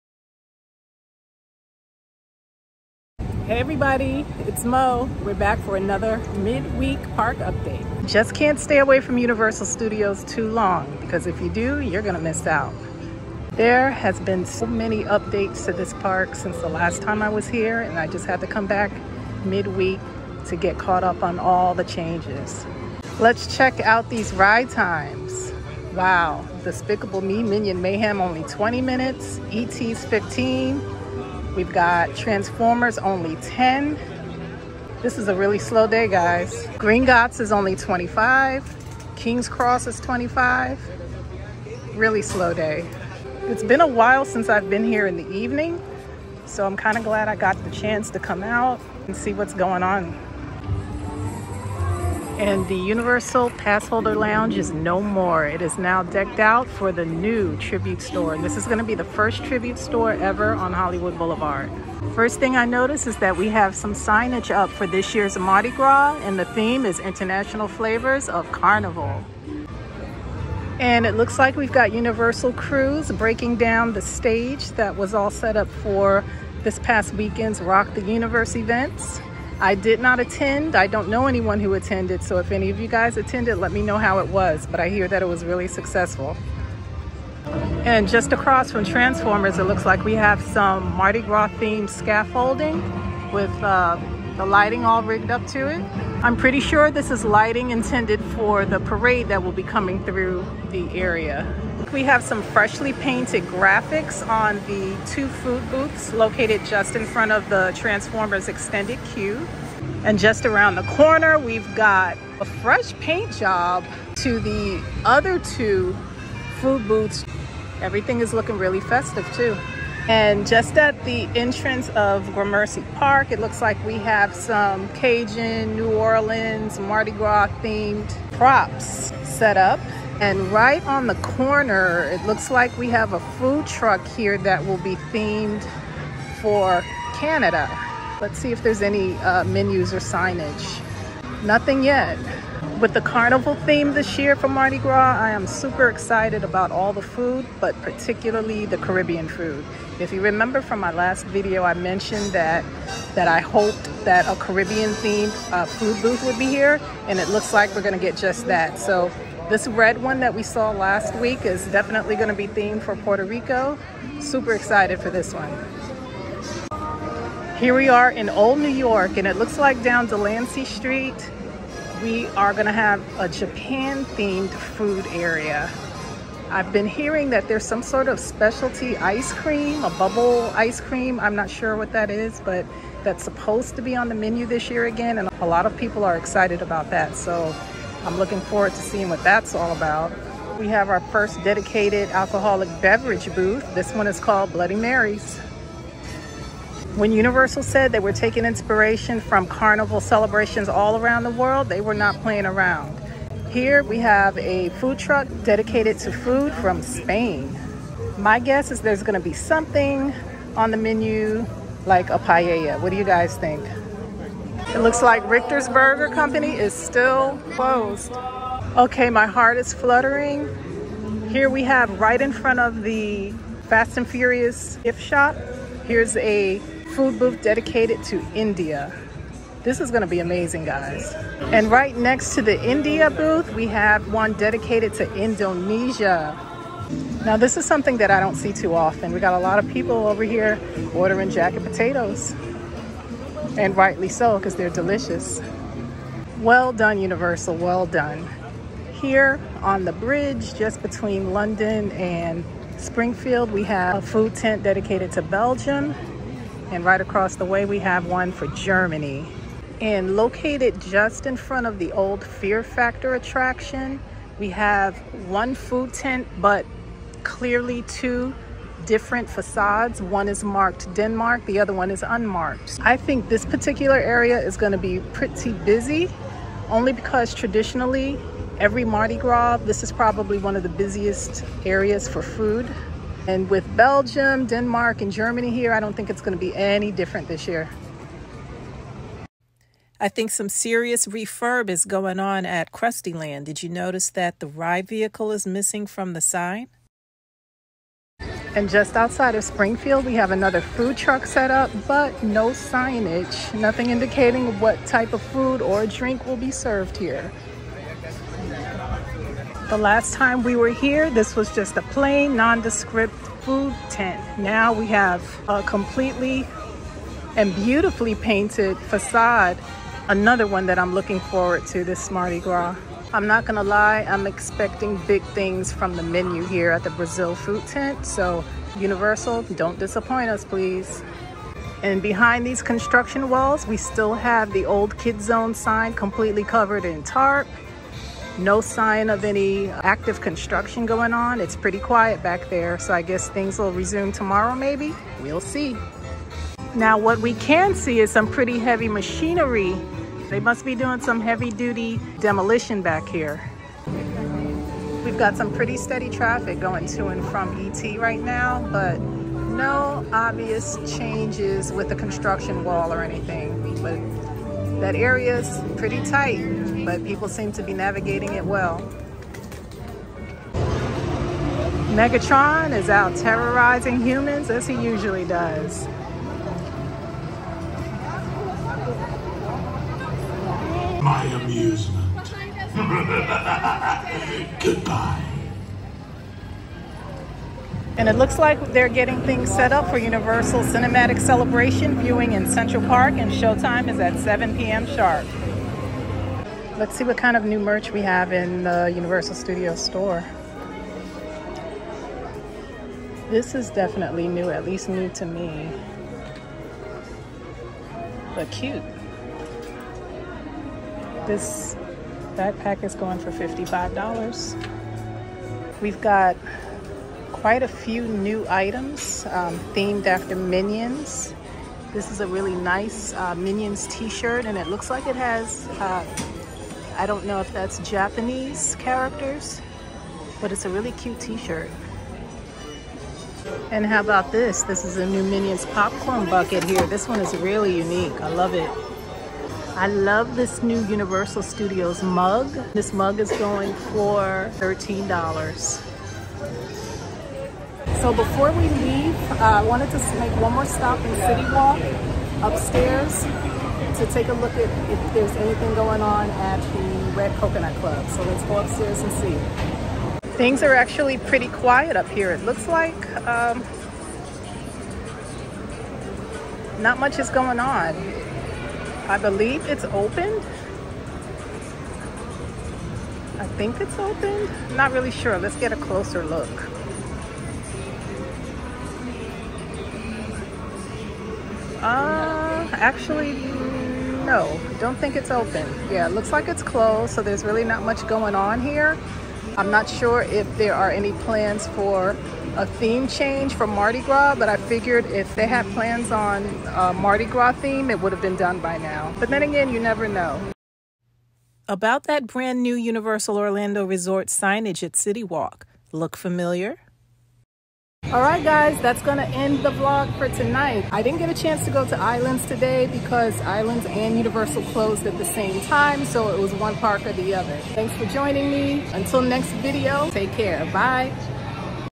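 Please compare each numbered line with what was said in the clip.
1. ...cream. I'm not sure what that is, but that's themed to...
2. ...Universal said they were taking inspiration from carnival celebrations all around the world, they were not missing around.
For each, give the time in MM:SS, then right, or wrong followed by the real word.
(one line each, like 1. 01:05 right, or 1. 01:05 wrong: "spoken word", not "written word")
1. 03:00 wrong: "supposed", not "themed"
2. 03:17 wrong: "playing", not "missing".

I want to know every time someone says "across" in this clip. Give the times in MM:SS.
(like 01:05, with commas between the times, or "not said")
01:28, 04:17.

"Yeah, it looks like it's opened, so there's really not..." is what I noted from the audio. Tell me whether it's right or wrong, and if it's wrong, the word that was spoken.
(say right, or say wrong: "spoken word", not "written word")
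wrong: "closed", not "opened".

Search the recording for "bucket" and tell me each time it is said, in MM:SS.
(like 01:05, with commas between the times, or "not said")
07:16.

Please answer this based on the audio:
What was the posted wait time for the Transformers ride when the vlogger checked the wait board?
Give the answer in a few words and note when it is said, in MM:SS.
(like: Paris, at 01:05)
10 minutes, at 00:33.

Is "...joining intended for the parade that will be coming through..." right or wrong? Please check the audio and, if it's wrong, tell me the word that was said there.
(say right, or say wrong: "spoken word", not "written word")
wrong: "lighting", not "joining".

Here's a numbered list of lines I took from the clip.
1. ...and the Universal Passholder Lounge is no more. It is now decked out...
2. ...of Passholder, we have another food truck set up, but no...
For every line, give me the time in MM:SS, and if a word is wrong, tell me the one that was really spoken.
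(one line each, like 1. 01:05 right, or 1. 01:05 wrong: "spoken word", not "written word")
1. 00:52 right
2. 04:59 wrong: "Springfield", not "Passholder".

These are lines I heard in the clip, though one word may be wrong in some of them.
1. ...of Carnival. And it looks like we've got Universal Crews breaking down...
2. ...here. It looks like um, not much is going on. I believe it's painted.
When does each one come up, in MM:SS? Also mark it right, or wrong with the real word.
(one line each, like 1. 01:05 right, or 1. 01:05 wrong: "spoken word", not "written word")
1. 01:08 right
2. 07:42 wrong: "opened", not "painted".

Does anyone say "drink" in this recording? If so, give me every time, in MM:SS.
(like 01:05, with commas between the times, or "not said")
05:05.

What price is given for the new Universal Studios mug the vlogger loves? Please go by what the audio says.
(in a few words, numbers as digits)
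$13.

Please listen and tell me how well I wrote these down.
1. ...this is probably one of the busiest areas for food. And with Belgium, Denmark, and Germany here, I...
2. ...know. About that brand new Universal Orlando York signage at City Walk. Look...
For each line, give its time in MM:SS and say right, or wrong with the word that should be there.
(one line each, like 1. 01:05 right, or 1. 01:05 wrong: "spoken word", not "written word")
1. 04:39 right
2. 08:20 wrong: "Resort", not "York".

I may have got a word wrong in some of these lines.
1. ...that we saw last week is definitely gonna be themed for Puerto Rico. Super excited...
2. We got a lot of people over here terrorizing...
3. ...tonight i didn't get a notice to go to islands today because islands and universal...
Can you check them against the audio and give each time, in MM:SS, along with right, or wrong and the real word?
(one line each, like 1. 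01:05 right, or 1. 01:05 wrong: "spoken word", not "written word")
1. 02:40 right
2. 03:59 wrong: "ordering", not "terrorizing"
3. 08:30 wrong: "chance", not "notice".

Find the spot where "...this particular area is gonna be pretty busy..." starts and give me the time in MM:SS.
04:33.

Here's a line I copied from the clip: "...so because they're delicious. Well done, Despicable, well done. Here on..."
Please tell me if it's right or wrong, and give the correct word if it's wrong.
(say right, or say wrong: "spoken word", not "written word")
wrong: "Universal", not "Despicable".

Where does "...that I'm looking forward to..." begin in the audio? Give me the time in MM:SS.
05:20.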